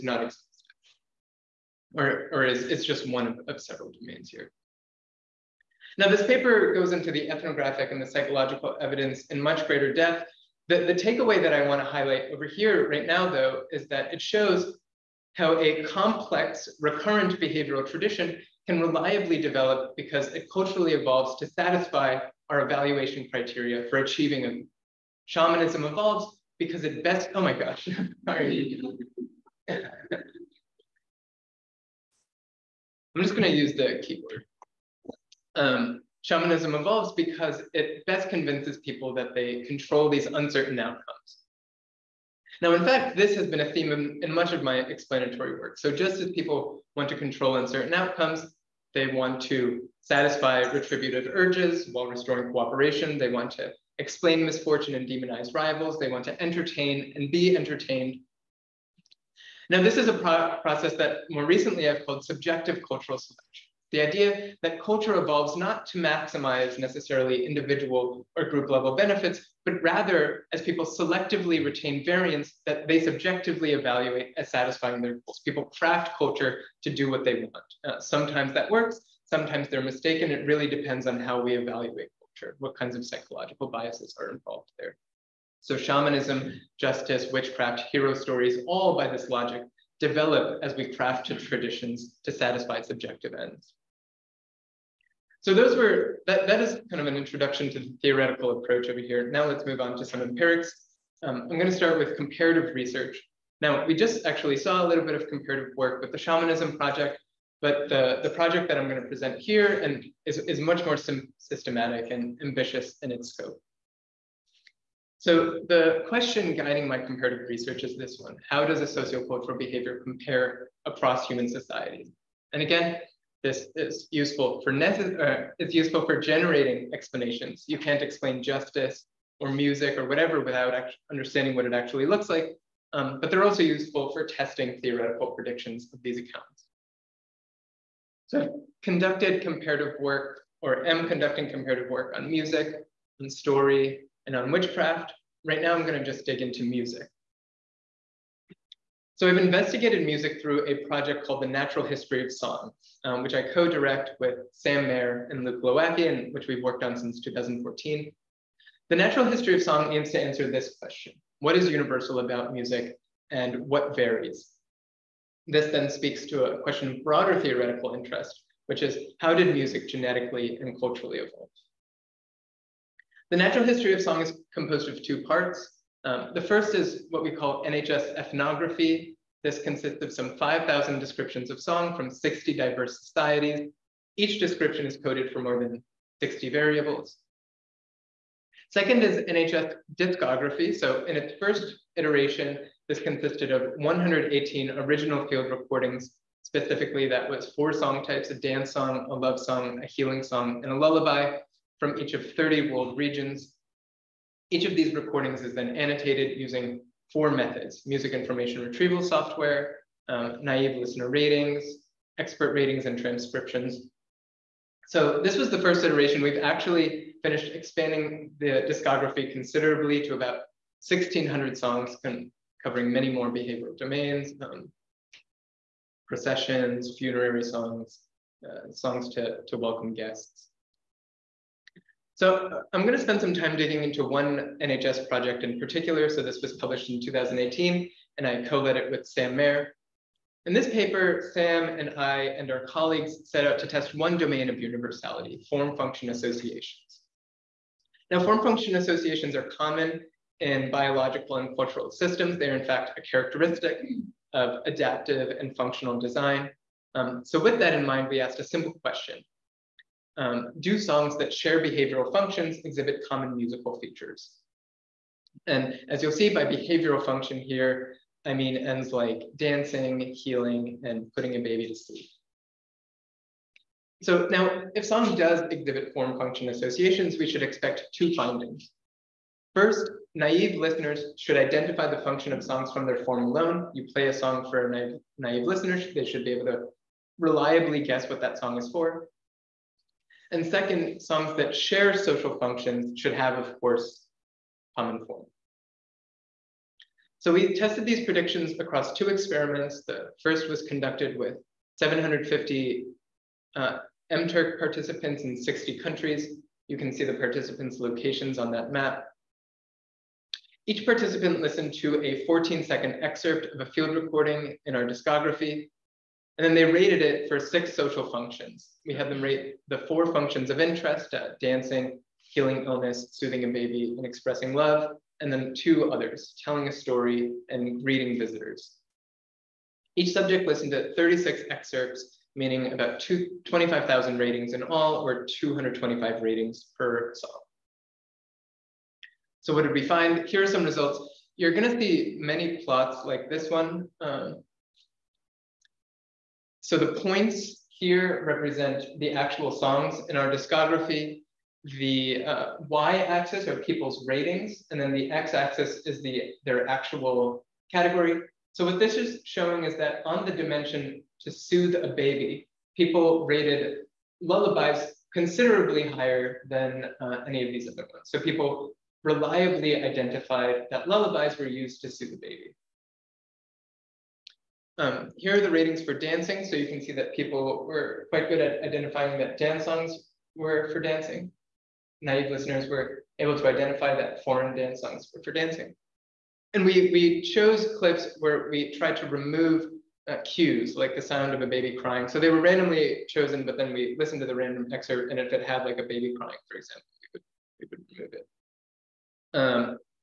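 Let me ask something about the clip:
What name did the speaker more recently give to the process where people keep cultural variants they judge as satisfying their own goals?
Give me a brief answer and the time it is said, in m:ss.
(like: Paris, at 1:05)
subjective cultural selection, at 1:02.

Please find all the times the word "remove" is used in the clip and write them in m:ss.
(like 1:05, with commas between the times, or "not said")
6:29, 6:38.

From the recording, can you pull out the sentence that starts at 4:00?
In this paper, Sam and I and our colleagues set out to test one domain of universality, form-function associations.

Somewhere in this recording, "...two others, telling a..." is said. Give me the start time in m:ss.
5:25.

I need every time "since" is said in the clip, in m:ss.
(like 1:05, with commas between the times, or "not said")
2:36.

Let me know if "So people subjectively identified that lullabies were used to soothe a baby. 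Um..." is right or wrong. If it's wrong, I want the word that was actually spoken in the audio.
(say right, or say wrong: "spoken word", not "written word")
wrong: "reliably", not "subjectively".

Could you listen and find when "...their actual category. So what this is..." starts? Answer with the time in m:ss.
5:56.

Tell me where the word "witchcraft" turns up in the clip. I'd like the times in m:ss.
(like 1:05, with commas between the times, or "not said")
1:27, 2:24.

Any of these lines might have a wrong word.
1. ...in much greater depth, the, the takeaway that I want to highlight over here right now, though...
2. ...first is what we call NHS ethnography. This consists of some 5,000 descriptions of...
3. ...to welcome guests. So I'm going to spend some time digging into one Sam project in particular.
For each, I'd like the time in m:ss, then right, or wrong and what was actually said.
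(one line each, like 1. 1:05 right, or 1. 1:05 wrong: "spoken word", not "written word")
1. 0:09 right
2. 2:56 right
3. 3:49 wrong: "NHS", not "Sam".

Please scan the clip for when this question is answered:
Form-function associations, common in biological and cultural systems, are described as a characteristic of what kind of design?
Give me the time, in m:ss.
4:14.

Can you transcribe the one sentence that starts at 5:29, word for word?
Each subject listened to 36 excerpts, meaning about 25,000 ratings in all, or 225 ratings per song.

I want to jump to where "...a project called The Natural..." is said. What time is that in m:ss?
2:30.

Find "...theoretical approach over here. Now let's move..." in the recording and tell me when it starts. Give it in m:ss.
1:38.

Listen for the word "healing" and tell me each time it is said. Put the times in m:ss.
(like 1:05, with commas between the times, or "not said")
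3:19, 4:30, 5:22.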